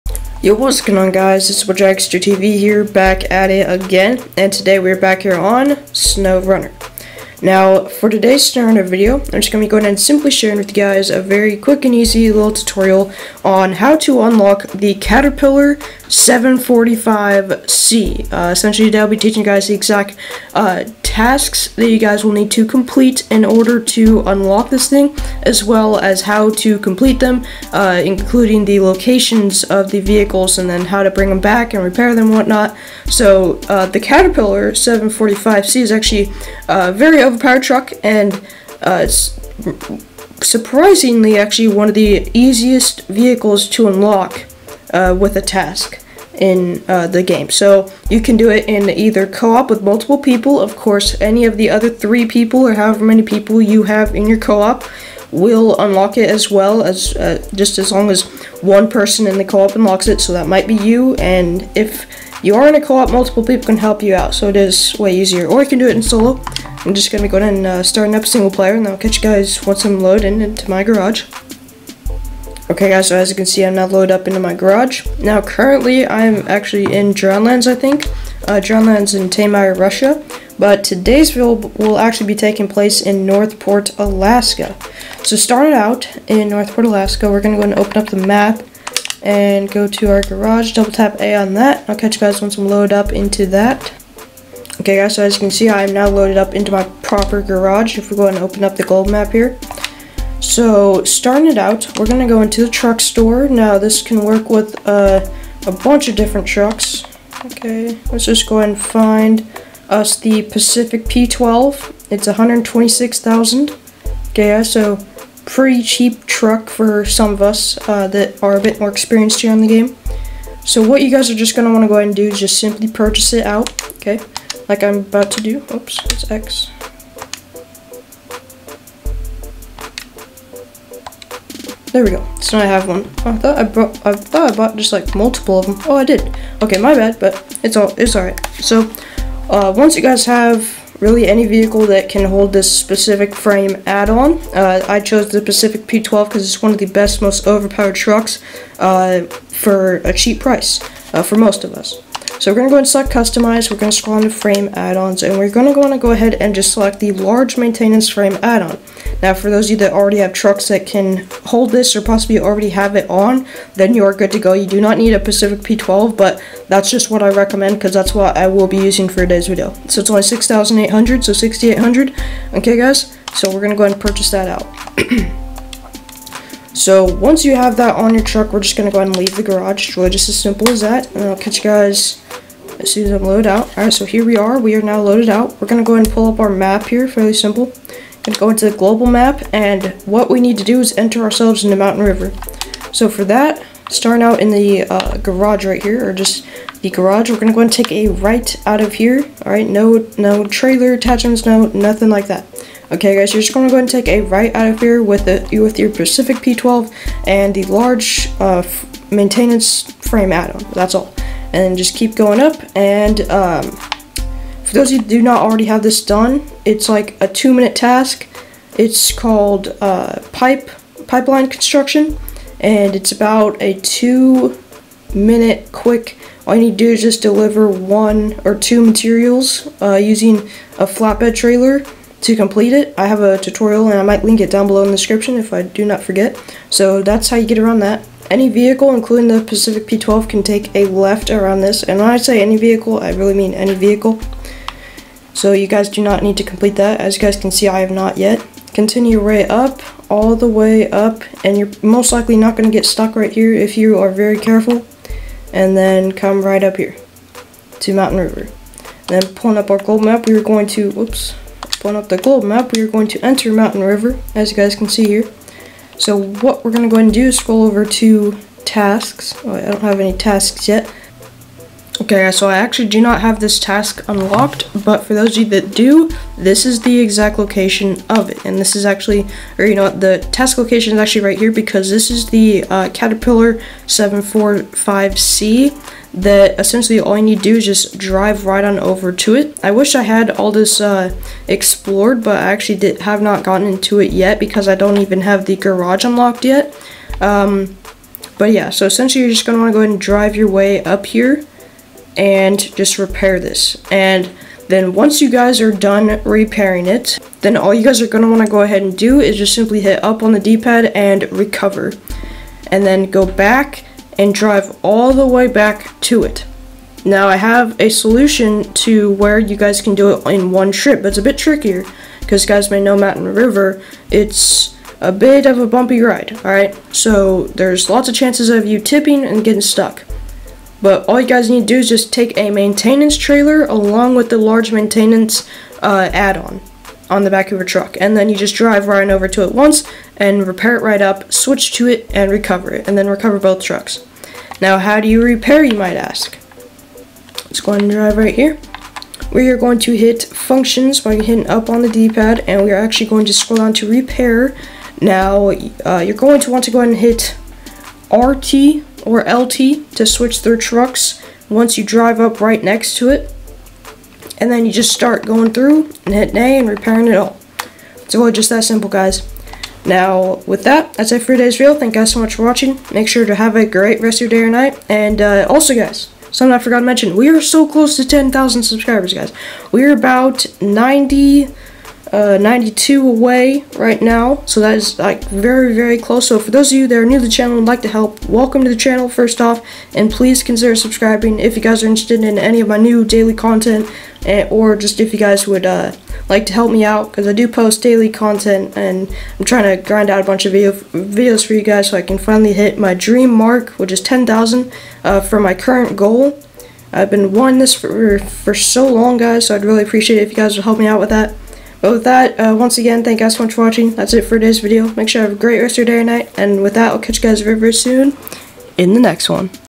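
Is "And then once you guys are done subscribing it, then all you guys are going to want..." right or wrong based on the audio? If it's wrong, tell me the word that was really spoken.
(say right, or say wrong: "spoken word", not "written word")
wrong: "repairing", not "subscribing".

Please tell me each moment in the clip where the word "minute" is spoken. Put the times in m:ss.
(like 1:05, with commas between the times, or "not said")
3:37, 3:45.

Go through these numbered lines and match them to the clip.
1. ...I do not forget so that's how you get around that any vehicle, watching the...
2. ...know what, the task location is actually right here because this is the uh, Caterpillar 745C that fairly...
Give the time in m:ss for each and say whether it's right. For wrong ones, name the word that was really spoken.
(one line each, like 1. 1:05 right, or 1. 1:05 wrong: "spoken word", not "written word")
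1. 3:55 wrong: "including", not "watching"
2. 4:39 wrong: "essentially", not "fairly".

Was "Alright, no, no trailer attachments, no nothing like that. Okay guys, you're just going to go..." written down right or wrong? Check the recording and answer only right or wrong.
right.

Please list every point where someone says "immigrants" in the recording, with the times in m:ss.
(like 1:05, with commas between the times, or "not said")
not said.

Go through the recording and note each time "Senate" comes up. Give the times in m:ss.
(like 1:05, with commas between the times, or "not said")
not said.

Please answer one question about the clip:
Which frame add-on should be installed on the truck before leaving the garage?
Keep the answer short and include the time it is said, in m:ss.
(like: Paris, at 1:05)
large maintenance frame add-on, at 2:37.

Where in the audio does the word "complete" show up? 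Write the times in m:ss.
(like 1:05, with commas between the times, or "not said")
0:22, 0:26, 3:52, 4:06.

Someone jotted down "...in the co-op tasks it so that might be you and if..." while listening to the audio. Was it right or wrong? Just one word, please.
wrong.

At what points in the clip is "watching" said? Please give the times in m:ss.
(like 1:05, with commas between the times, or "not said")
6:12, 6:53.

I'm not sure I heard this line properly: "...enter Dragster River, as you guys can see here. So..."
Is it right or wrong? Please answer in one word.
wrong.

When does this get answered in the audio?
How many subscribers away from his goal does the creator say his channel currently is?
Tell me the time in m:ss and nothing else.
6:22.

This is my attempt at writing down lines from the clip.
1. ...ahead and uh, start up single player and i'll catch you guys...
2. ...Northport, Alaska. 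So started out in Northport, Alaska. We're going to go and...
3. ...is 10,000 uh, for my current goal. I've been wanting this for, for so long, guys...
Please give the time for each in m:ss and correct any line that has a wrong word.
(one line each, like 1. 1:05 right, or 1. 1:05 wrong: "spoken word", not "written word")
1. 1:07 right
2. 1:23 right
3. 6:43 right.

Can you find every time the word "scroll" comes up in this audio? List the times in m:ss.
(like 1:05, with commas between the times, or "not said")
2:33, 4:27, 5:53.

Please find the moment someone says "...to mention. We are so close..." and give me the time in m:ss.
6:16.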